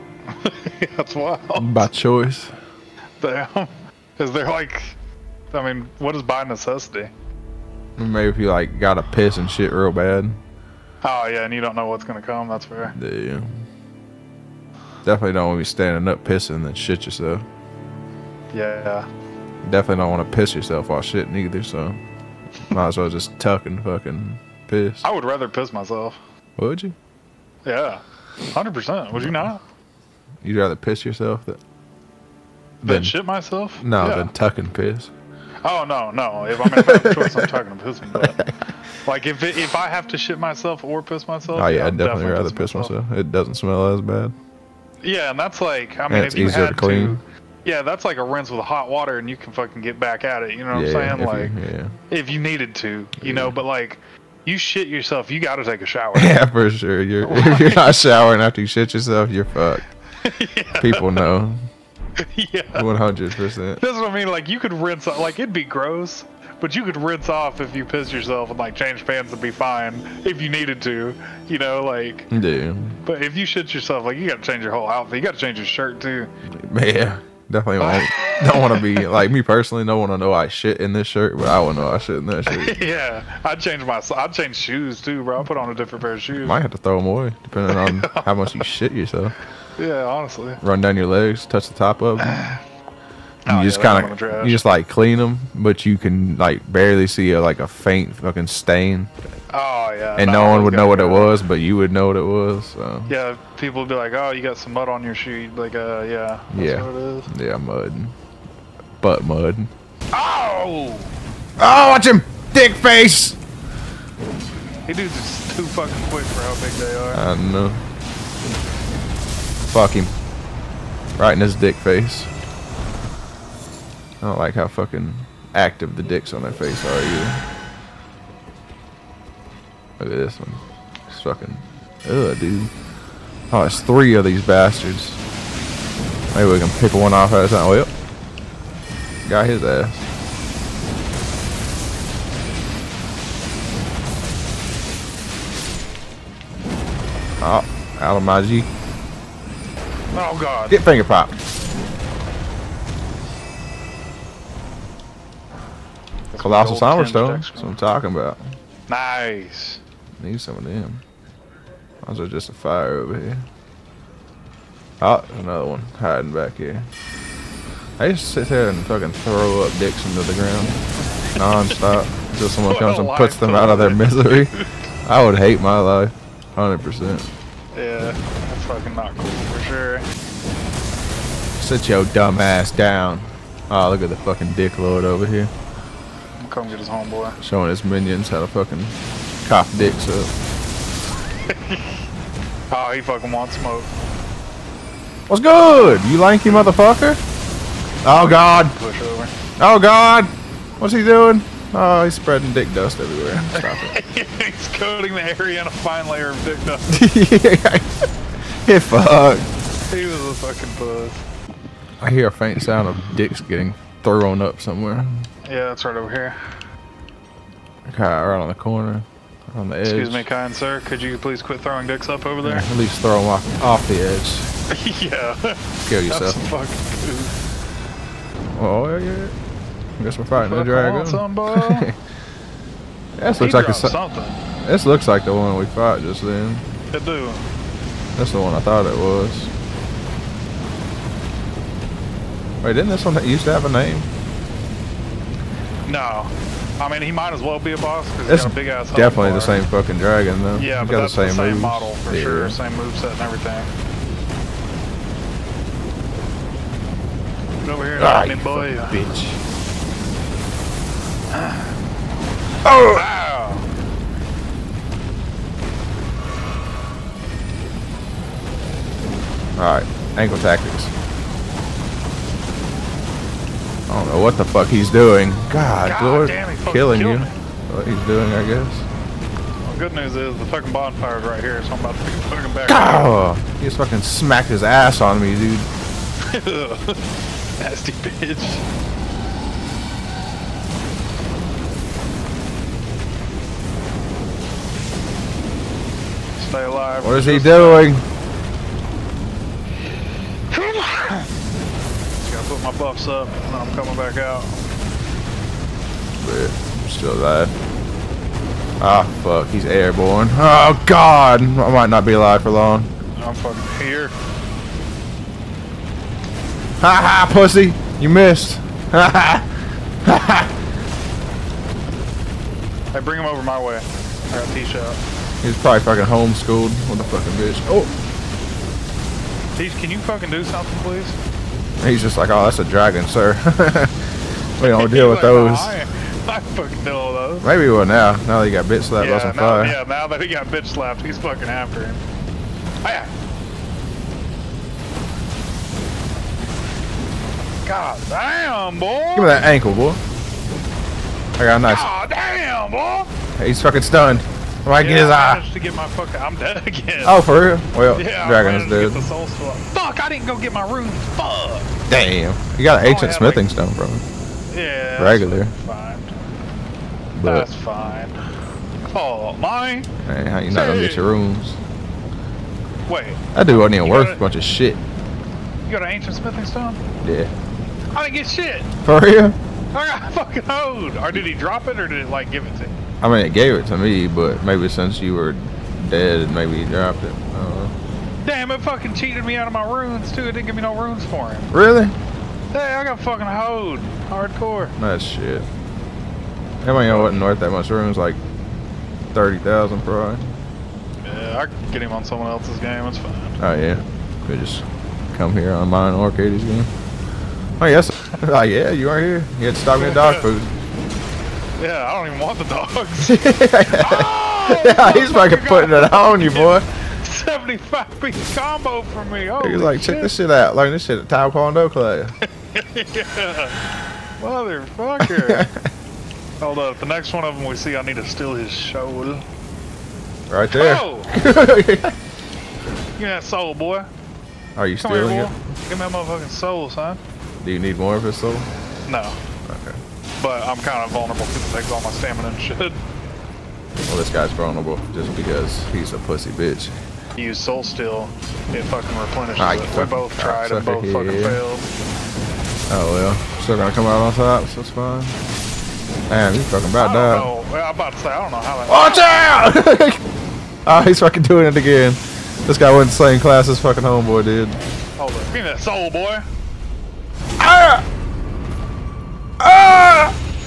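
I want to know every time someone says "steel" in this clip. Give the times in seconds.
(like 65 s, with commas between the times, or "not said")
447 s.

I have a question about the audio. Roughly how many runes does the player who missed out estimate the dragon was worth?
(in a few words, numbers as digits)
30,000.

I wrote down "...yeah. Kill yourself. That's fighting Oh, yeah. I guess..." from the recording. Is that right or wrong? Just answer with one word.
wrong.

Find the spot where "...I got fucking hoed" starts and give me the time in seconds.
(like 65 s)
392 s.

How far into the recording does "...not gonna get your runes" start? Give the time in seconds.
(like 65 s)
370 s.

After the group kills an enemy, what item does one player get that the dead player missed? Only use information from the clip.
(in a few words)
Colossal Silverstone.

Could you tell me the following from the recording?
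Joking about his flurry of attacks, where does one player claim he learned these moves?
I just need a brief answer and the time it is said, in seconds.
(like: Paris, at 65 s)
Taekwondo class, at 421 s.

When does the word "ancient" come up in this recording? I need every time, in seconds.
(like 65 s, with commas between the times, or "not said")
362 s, 375 s.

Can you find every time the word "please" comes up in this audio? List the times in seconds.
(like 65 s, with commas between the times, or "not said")
221 s, 330 s.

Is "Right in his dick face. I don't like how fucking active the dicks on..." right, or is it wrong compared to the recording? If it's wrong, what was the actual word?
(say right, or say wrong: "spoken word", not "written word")
right.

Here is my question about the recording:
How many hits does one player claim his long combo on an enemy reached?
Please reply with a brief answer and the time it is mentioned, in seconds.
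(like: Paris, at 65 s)
75, at 417 s.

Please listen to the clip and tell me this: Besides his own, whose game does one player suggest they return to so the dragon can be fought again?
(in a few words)
Katie's.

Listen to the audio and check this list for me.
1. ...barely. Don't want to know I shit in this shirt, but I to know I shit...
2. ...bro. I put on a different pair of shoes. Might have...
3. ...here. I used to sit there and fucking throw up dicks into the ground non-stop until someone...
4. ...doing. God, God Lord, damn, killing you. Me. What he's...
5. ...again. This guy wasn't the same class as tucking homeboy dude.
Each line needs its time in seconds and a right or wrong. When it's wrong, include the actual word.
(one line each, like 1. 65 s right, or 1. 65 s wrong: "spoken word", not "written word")
1. 79 s wrong: "personally", not "barely"
2. 85 s right
3. 166 s right
4. 274 s right
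5. 461 s wrong: "fucking", not "tucking".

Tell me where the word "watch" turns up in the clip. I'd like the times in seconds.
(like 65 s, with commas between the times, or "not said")
111 s, 459 s.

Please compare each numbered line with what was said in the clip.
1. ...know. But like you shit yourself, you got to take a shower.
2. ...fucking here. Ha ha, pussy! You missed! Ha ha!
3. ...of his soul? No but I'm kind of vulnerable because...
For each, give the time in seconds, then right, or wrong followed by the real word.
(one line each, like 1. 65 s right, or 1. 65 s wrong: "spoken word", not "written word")
1. 53 s right
2. 313 s right
3. 437 s right.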